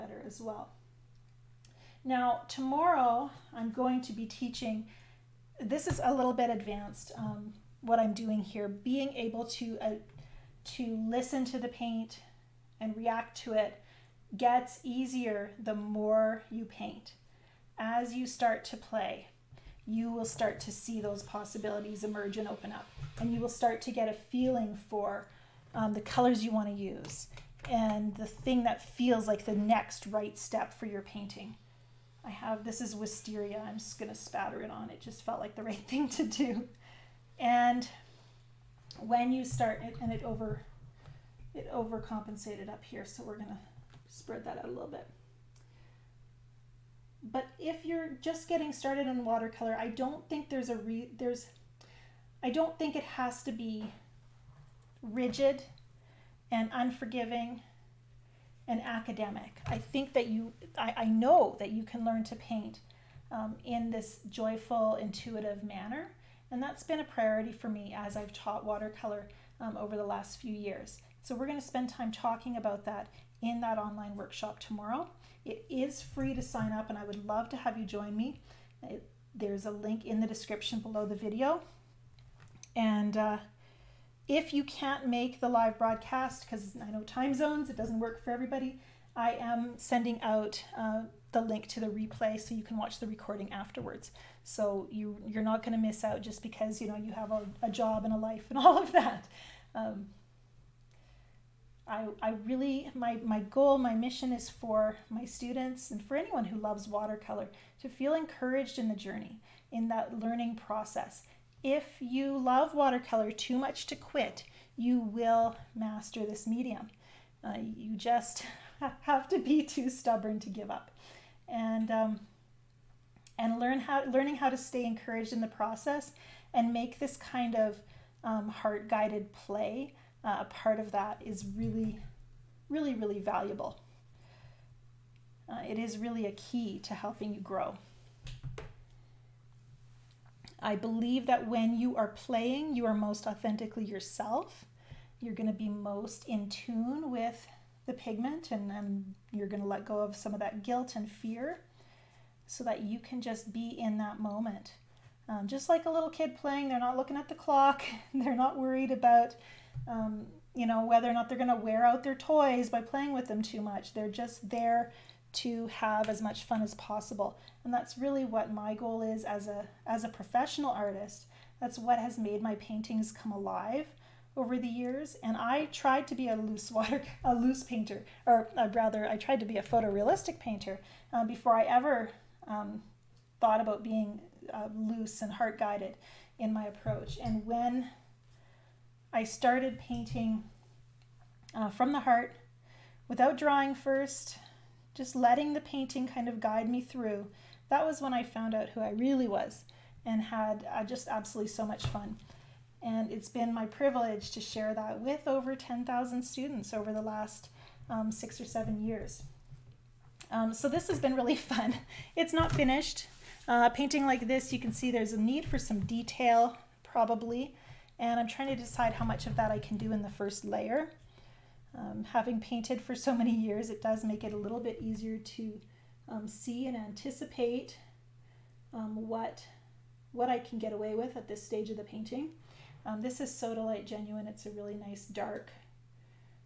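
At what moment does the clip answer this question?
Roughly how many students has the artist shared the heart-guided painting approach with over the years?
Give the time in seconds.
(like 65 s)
205 s.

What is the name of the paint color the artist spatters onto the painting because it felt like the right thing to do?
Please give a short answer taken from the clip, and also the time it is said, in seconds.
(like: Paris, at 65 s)
Wisteria, at 32 s.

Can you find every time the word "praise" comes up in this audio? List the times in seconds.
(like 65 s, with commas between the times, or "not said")
not said.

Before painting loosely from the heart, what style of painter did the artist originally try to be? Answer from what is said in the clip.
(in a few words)
Photorealistic.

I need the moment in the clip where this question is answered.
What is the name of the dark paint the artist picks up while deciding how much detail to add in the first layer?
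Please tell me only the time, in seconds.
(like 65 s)
233 s.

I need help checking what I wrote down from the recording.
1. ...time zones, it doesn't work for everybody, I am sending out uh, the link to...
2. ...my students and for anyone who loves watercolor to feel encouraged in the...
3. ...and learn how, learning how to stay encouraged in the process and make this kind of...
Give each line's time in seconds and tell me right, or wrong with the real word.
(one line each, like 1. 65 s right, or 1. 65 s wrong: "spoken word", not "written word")
1. 87 s right
2. 105 s right
3. 123 s right.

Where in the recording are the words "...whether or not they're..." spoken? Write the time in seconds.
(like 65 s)
160 s.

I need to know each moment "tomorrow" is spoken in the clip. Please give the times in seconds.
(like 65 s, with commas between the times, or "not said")
2 s, 74 s.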